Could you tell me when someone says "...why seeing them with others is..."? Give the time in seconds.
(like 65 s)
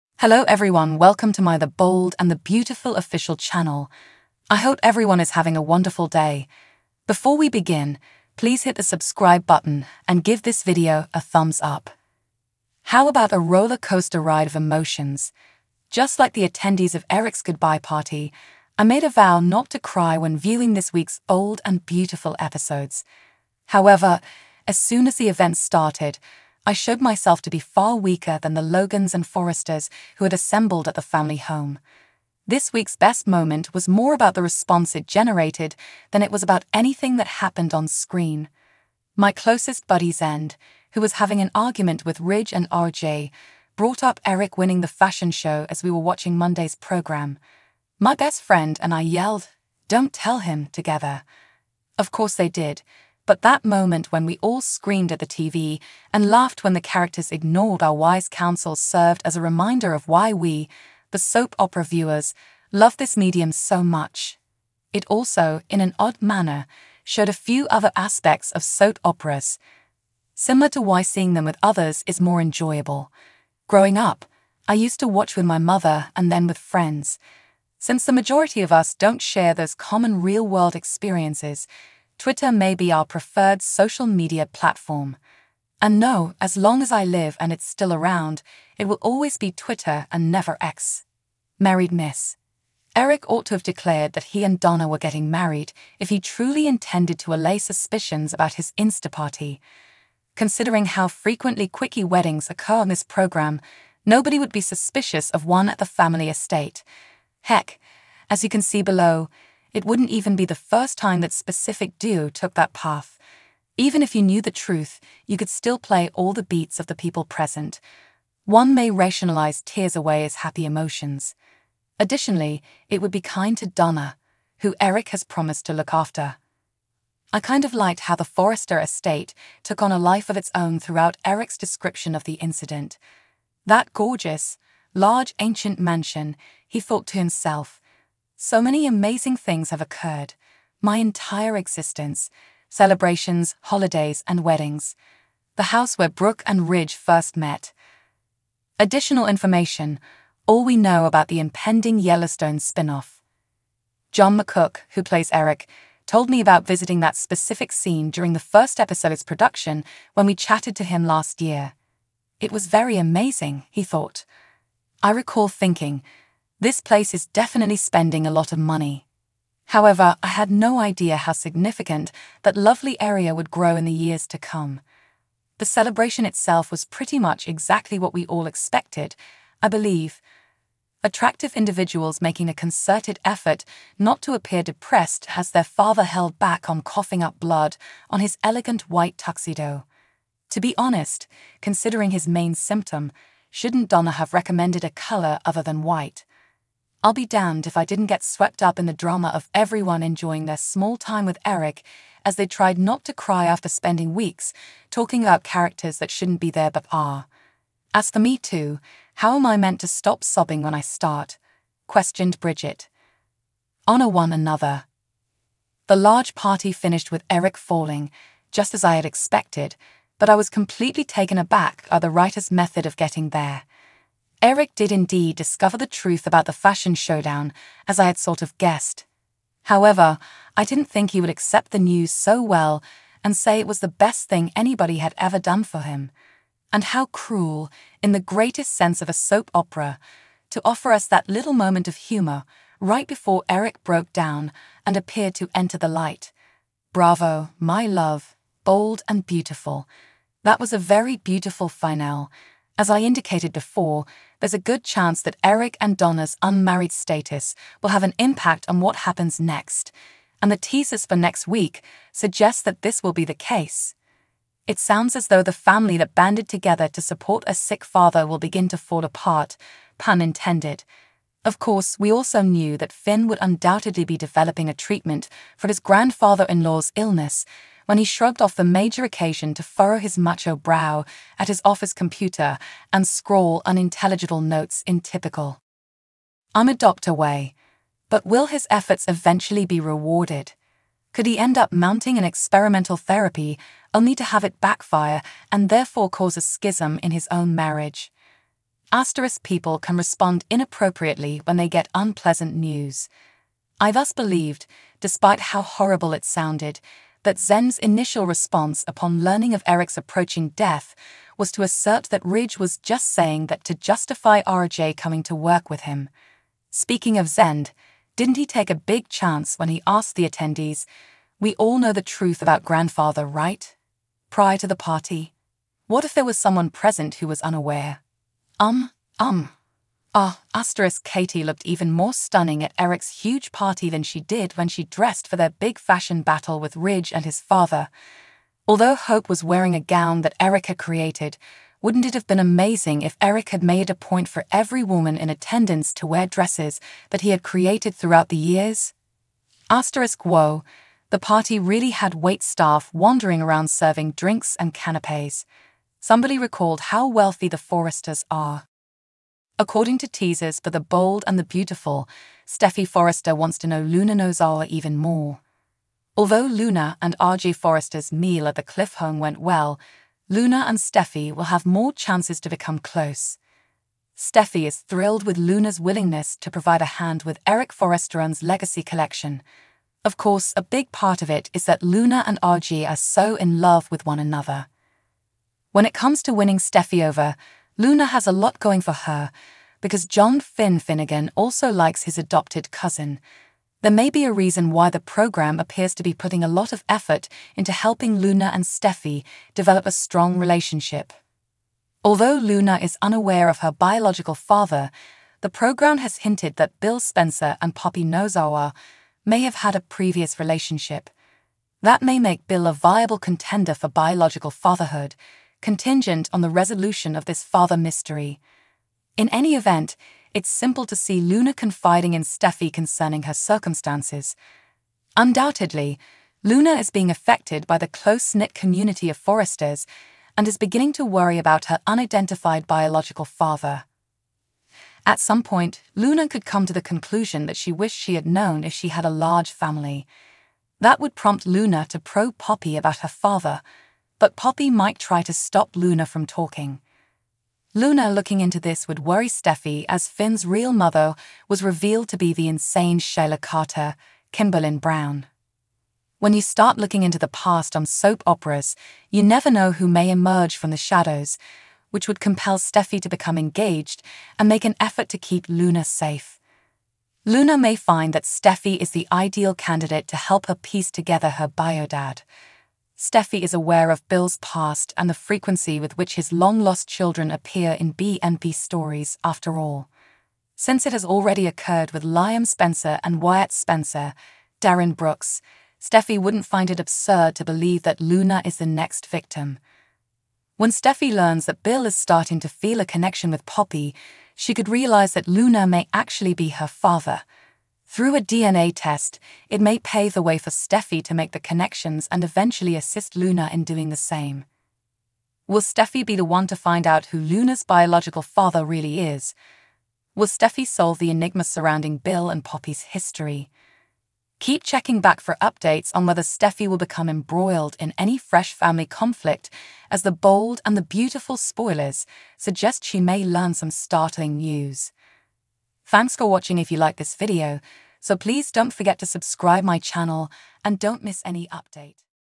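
70 s.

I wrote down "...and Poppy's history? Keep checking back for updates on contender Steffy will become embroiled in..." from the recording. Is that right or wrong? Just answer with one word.
wrong.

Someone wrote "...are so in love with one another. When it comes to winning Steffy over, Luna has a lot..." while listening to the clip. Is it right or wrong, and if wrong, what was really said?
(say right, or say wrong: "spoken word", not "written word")
right.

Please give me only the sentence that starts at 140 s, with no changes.
My entire existence celebrations, holidays, and weddings.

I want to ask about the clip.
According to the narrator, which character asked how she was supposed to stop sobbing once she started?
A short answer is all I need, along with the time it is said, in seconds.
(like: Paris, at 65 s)
Bridget, at 212 s.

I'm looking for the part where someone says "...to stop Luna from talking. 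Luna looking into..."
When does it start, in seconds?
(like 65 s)
445 s.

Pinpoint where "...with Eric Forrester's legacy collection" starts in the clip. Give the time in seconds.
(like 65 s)
377 s.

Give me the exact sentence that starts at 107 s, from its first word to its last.
Heck, as you can see below, it wouldn't even be the first time that specific duo took that path.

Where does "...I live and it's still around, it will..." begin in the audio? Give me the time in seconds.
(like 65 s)
86 s.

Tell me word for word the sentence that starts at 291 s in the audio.
Could he end up mounting an experimental therapy only to have it backfire and therefore cause a schism in his own marriage?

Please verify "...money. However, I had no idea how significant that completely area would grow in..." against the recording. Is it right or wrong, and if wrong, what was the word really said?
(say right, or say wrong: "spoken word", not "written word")
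wrong: "lovely", not "completely".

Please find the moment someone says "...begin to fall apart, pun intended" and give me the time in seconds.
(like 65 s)
268 s.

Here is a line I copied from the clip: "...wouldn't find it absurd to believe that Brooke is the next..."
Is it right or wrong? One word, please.
wrong.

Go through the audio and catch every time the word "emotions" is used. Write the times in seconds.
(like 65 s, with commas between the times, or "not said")
14 s, 120 s.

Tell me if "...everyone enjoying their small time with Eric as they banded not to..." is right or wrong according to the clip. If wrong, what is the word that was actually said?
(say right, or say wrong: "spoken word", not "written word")
wrong: "tried", not "banded".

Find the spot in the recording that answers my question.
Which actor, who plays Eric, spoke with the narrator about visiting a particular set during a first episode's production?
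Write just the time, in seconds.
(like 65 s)
154 s.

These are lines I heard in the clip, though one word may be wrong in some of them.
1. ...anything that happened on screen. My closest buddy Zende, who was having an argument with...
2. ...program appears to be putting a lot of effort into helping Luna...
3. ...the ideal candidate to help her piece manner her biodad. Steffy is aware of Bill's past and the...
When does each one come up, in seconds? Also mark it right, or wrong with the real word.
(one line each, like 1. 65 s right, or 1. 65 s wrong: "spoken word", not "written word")
1. 36 s right
2. 394 s right
3. 468 s wrong: "together", not "manner".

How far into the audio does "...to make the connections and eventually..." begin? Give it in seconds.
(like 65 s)
501 s.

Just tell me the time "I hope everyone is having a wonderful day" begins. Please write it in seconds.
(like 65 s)
4 s.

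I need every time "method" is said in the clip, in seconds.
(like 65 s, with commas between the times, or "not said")
222 s.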